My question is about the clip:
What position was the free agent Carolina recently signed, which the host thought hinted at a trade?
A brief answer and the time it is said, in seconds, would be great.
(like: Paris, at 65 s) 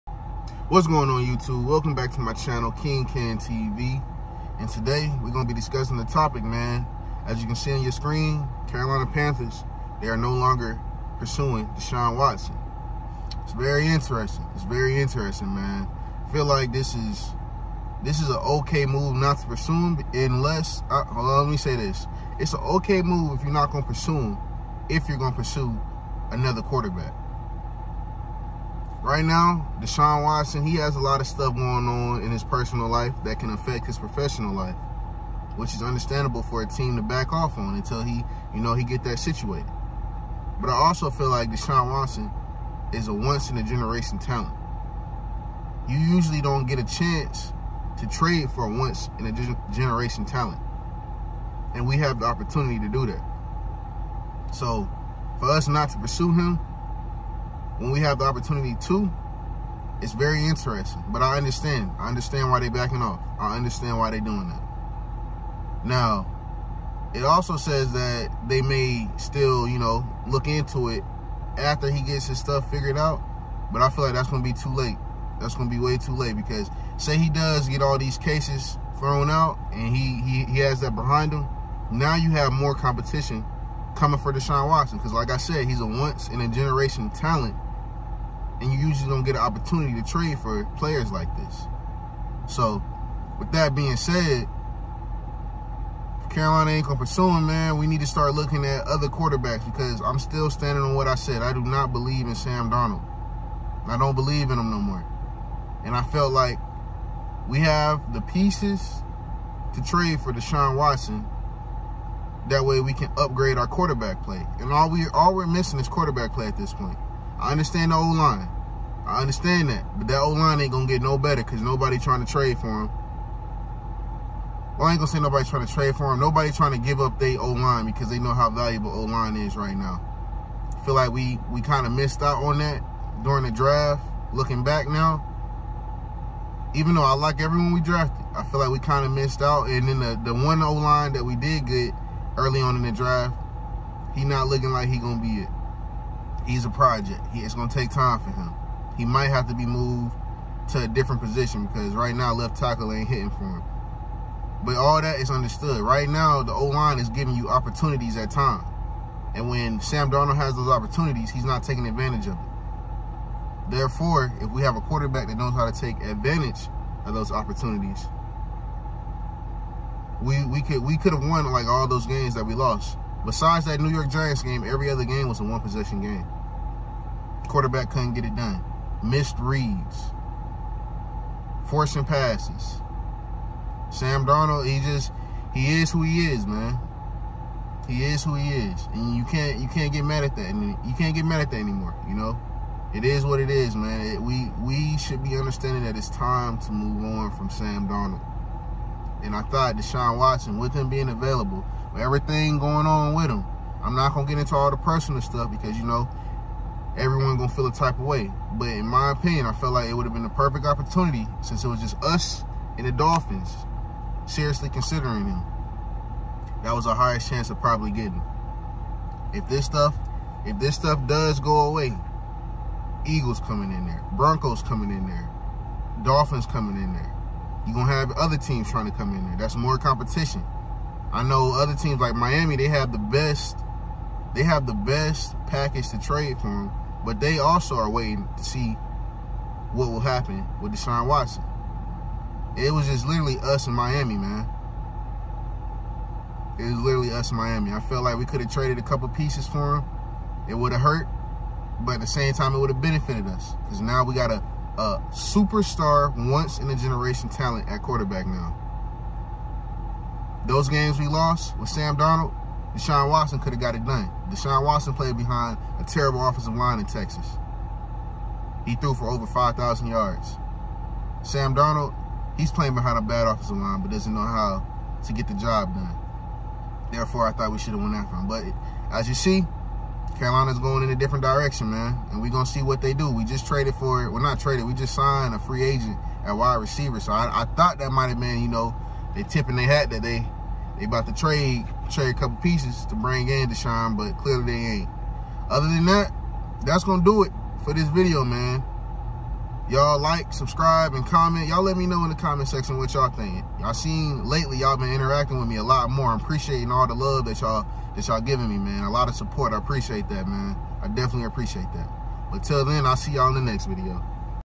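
Wide receiver, at 286 s.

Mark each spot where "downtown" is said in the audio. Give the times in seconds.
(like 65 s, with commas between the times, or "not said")
not said.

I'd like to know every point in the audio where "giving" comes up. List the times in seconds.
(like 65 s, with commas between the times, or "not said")
157 s, 308 s.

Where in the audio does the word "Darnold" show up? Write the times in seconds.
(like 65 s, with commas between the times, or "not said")
102 s, 160 s, 184 s, 197 s, 261 s, 271 s.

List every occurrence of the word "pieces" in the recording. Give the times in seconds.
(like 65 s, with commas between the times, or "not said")
108 s, 249 s, 292 s.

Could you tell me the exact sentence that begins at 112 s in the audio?
That way we can upgrade our quarterback play.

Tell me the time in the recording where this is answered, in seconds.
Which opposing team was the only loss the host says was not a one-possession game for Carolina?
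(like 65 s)
173 s.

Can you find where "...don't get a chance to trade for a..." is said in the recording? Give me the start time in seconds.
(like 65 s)
46 s.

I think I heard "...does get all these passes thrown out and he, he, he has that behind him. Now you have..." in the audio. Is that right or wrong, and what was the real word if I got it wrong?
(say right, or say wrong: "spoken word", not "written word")
wrong: "cases", not "passes".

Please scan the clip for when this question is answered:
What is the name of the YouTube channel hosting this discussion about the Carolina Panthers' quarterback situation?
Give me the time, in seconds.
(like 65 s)
2 s.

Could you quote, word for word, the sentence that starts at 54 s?
So, for us not to pursue him, when we have the opportunity to, it's very interesting.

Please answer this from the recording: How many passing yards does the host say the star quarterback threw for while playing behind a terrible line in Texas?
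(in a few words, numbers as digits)
Over 5,000.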